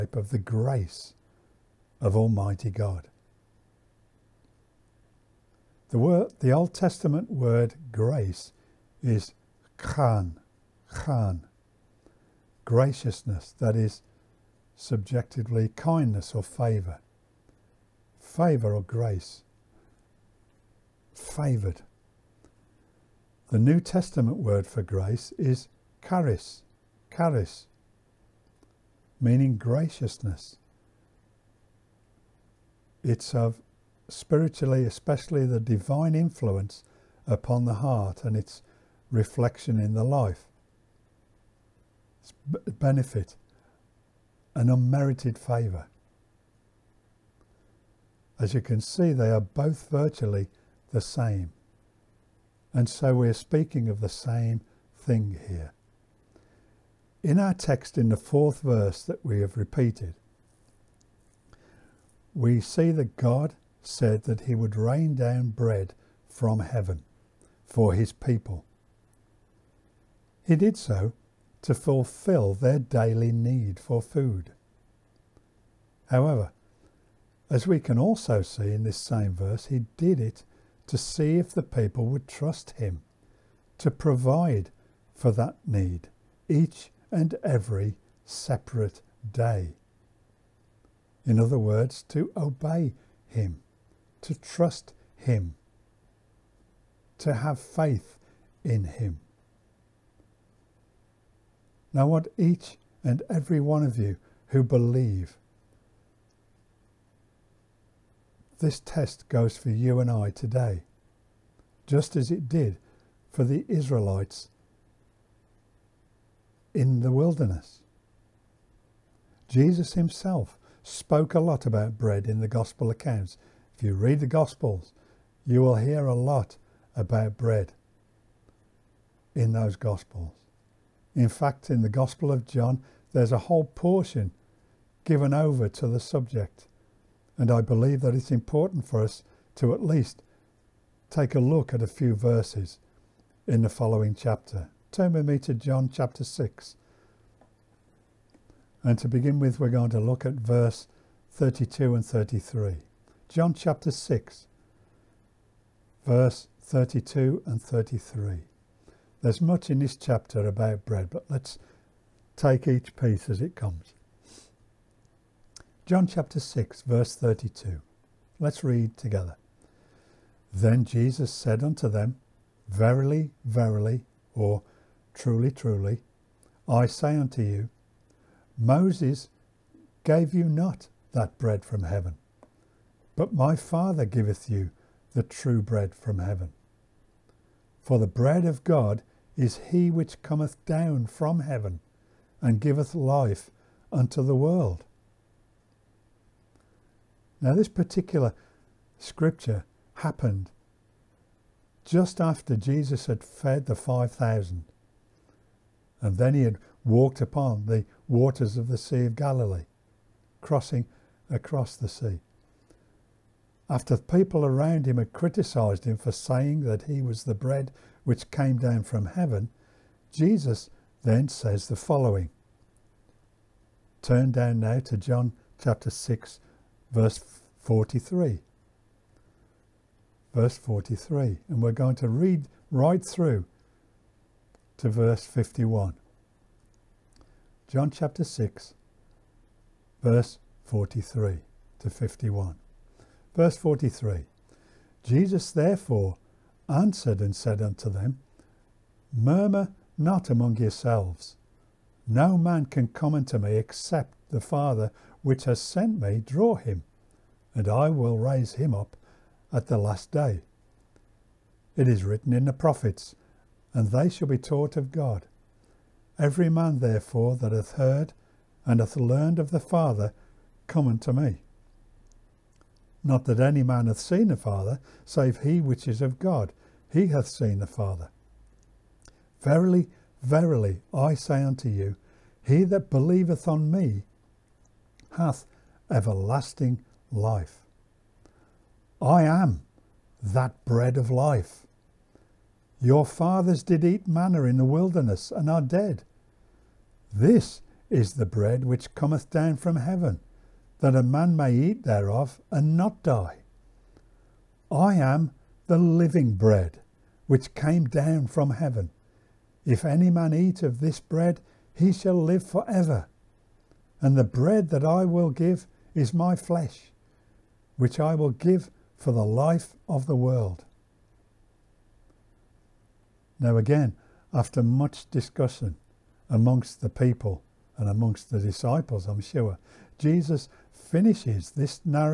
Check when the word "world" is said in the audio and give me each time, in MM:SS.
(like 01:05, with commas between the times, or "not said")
03:14, 05:20.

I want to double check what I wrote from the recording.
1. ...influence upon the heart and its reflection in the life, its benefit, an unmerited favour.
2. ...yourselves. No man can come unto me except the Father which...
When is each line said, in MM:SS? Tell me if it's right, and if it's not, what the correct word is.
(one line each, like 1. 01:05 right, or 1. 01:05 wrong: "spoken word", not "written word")
1. 00:36 right
2. 04:10 right.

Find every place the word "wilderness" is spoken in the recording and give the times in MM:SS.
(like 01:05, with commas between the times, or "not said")
01:57, 04:54.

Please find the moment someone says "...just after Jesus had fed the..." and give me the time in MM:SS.
03:21.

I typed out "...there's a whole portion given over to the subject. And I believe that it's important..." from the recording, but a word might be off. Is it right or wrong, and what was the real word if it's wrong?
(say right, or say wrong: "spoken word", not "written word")
right.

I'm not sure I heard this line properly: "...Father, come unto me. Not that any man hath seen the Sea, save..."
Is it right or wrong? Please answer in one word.
wrong.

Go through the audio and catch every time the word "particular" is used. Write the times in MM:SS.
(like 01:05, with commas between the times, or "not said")
03:17.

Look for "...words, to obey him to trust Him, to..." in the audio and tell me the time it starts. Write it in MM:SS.
01:31.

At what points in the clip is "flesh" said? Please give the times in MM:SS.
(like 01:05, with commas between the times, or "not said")
05:16.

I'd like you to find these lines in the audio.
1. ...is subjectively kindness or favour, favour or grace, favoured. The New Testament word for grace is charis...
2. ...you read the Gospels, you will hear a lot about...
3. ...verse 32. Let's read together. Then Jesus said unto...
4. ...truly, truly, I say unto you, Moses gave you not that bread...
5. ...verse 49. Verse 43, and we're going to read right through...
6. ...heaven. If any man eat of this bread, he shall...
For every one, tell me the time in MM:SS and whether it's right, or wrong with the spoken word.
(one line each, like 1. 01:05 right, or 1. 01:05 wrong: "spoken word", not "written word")
1. 00:13 right
2. 02:03 right
3. 02:46 right
4. 02:55 right
5. 03:46 wrong: "43", not "49"
6. 05:08 right.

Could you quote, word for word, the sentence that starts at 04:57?
This is the bread which cometh down from heaven, that a man may eat thereof and not die.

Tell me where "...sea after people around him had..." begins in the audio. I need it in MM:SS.
03:31.